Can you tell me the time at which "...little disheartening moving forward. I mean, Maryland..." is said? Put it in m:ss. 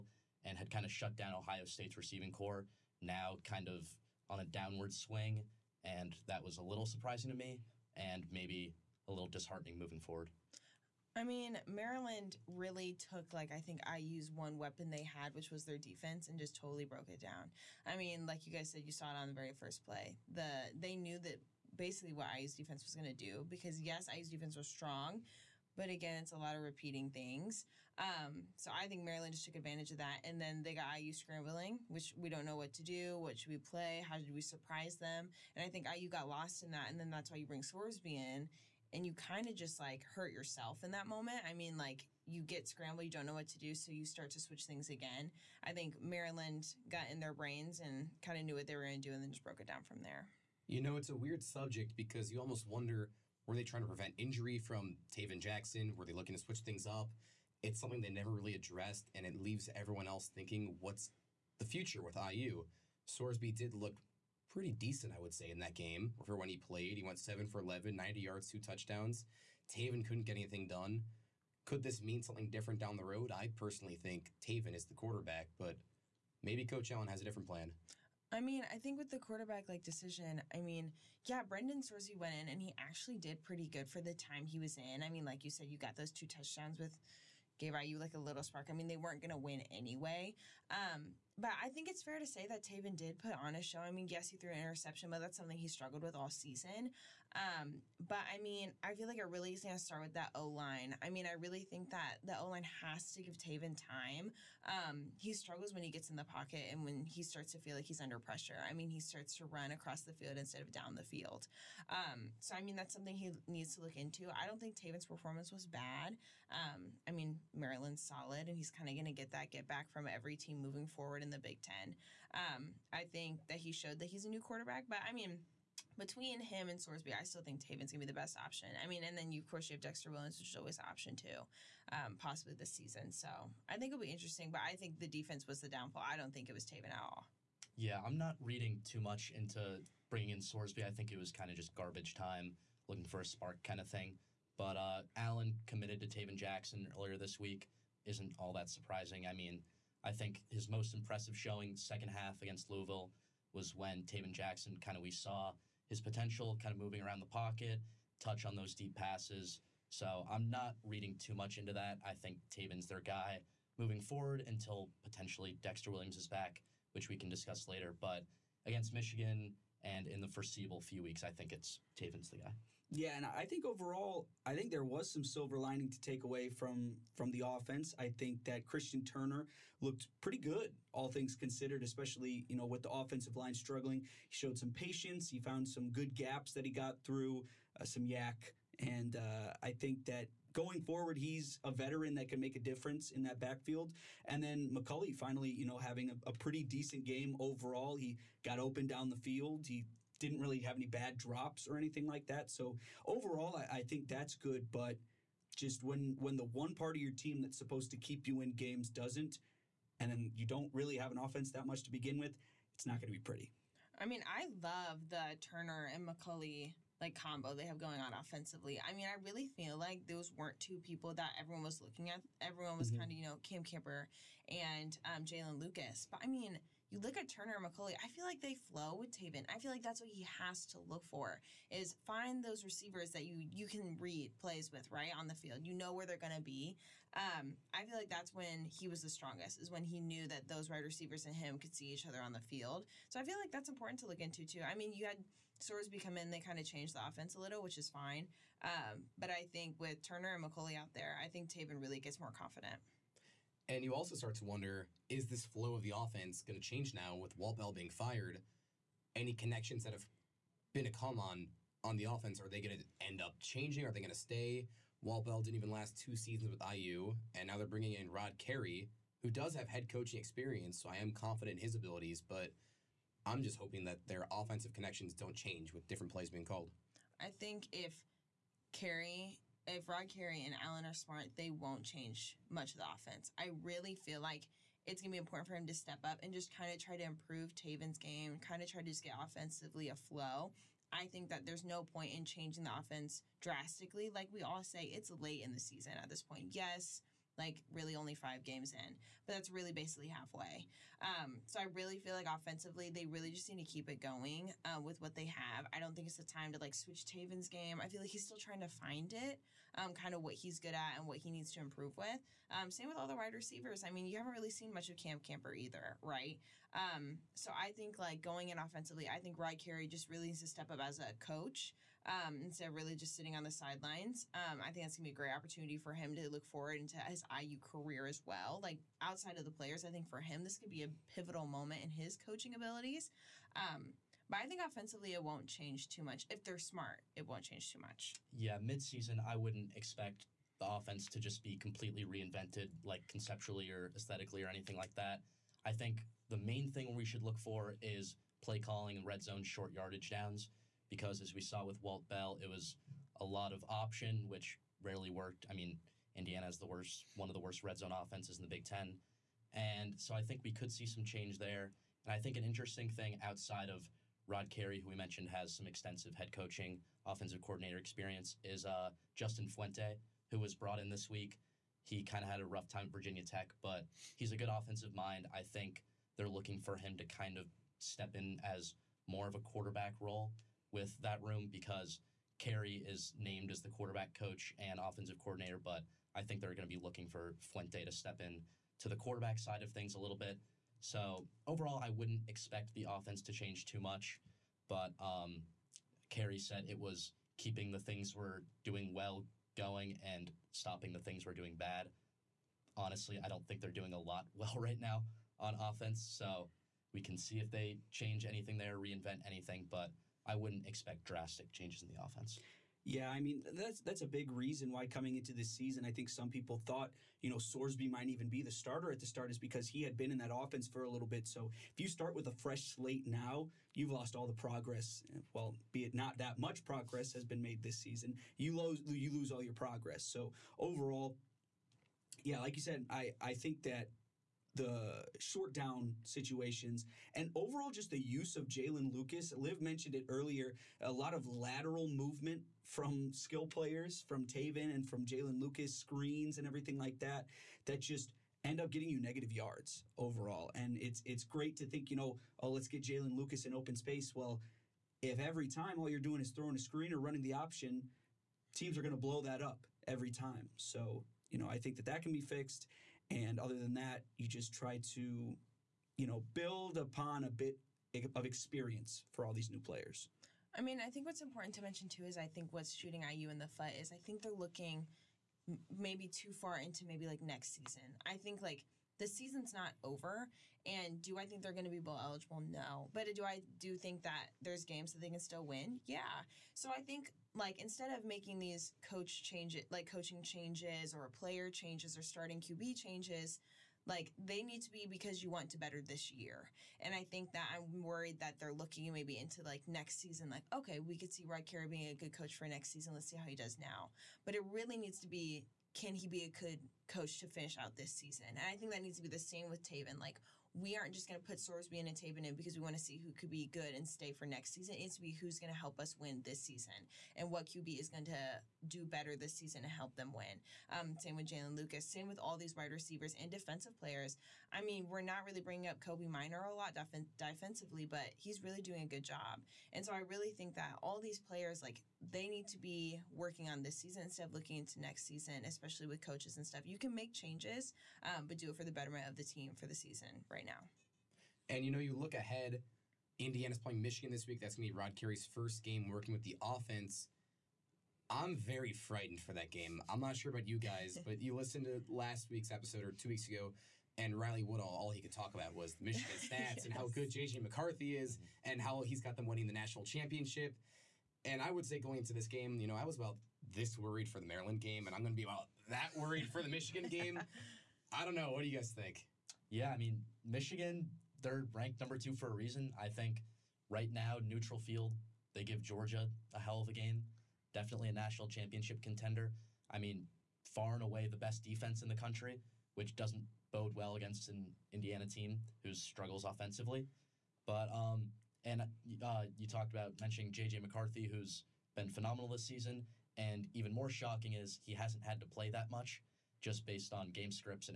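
0:09.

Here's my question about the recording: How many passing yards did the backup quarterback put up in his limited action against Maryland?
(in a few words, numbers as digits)
90.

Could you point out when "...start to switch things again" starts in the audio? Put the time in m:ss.
0:44.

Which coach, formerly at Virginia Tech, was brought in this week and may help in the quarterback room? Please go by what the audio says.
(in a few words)
Justin Fuente.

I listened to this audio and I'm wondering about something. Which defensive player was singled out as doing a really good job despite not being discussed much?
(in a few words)
Kobee Minor.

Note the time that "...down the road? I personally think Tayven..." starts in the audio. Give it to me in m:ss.
1:12.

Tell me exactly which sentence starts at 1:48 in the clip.
I mean, he starts to run across the field instead of down the field.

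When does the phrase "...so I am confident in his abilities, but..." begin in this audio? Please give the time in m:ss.
4:30.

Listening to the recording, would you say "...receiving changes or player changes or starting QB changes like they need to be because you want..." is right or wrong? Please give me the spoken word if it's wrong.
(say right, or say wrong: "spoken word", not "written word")
wrong: "coaching", not "receiving".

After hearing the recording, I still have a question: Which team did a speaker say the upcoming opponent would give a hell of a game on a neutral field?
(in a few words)
Georgia.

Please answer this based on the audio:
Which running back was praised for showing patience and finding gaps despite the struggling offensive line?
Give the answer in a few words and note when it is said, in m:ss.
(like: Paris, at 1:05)
Christian Turner, at 2:58.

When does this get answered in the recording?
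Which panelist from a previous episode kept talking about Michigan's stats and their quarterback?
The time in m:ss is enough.
9:14.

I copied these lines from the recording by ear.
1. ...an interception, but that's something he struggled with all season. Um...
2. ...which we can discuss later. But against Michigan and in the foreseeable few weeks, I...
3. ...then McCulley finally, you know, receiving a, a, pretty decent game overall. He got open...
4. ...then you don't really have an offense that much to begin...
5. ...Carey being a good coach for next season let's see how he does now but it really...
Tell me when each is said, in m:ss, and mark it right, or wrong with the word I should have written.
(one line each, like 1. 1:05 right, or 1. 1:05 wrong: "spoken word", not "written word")
1. 1:34 right
2. 2:46 right
3. 3:14 wrong: "having", not "receiving"
4. 3:30 right
5. 8:21 right.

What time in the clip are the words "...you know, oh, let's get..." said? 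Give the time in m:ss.
7:31.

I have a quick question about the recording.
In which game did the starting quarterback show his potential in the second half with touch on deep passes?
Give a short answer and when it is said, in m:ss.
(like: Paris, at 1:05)
Louisville, at 2:32.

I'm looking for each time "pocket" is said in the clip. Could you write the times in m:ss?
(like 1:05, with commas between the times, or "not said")
1:46, 2:37.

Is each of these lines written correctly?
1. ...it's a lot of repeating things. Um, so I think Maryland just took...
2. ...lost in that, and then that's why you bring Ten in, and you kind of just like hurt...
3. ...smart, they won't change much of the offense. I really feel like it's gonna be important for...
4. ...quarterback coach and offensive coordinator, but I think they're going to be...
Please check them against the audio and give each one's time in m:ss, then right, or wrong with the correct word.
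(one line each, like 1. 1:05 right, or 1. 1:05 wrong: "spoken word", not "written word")
1. 0:26 right
2. 0:36 wrong: "Sorsby", not "Ten"
3. 4:40 right
4. 6:23 right.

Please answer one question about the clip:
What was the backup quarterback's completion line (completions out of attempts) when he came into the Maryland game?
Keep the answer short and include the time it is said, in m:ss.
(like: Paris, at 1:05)
7 for 11, at 1:07.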